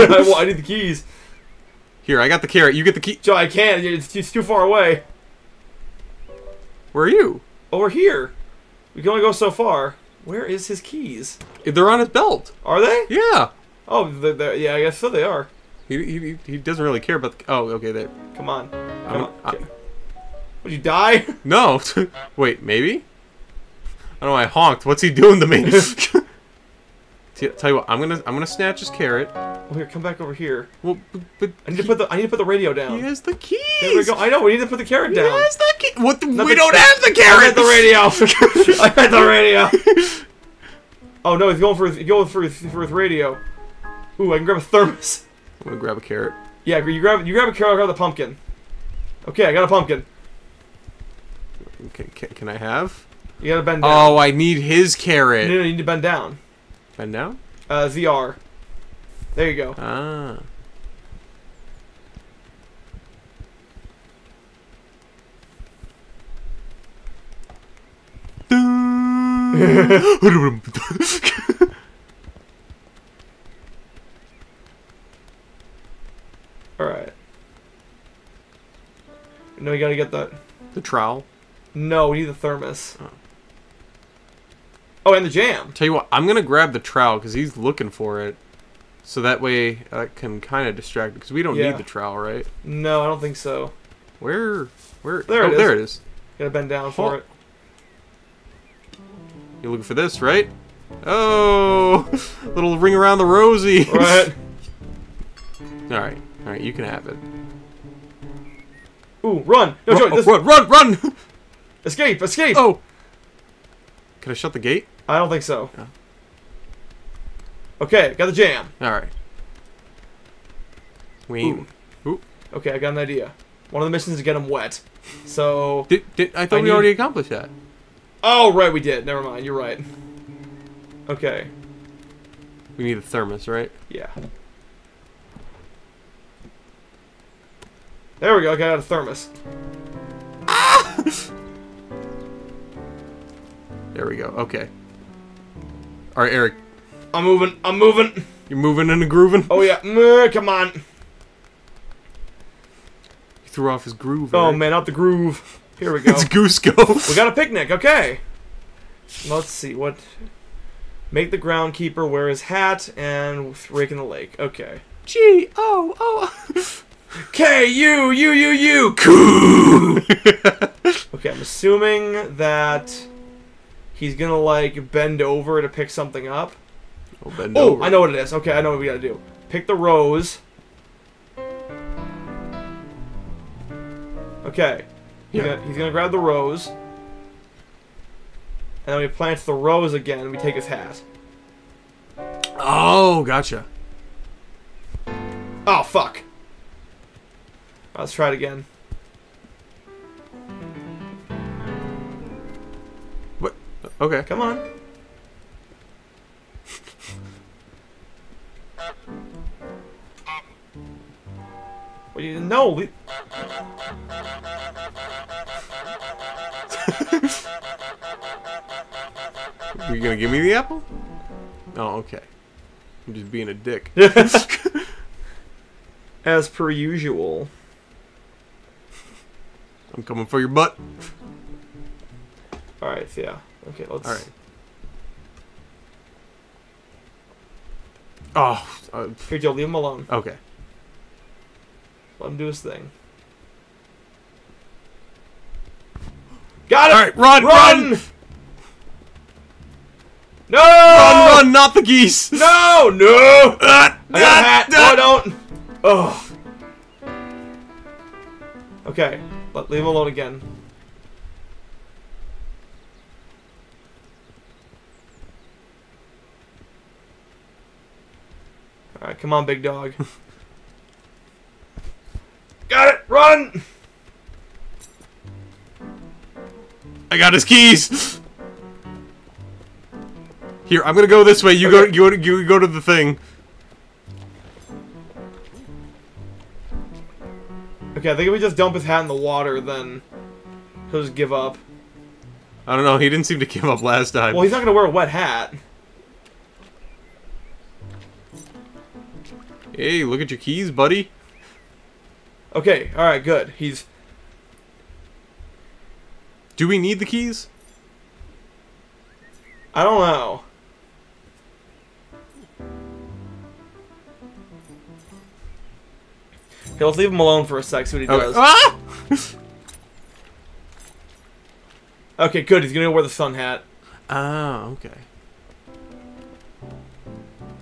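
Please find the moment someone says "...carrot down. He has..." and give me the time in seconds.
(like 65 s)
34 s.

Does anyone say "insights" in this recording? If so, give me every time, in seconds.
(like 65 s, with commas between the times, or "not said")
not said.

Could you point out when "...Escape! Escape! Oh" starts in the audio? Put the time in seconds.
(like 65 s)
111 s.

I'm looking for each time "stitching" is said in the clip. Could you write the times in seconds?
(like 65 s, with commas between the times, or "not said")
not said.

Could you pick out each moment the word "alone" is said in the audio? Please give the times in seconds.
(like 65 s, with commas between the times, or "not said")
239 s, 259 s, 317 s.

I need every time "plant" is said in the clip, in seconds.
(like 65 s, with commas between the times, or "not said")
189 s.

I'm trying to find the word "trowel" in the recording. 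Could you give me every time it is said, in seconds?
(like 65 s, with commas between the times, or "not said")
80 s, 86 s, 91 s.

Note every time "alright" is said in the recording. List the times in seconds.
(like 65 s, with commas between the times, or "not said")
76 s, 118 s, 232 s, 269 s, 302 s.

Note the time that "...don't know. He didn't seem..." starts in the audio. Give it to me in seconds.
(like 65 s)
292 s.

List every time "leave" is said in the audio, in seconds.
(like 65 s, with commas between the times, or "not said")
239 s, 259 s, 316 s.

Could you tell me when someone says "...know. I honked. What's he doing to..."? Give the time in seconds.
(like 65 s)
24 s.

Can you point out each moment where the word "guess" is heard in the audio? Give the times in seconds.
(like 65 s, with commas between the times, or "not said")
14 s.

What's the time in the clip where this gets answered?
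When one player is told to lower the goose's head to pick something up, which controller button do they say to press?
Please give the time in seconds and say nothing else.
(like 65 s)
57 s.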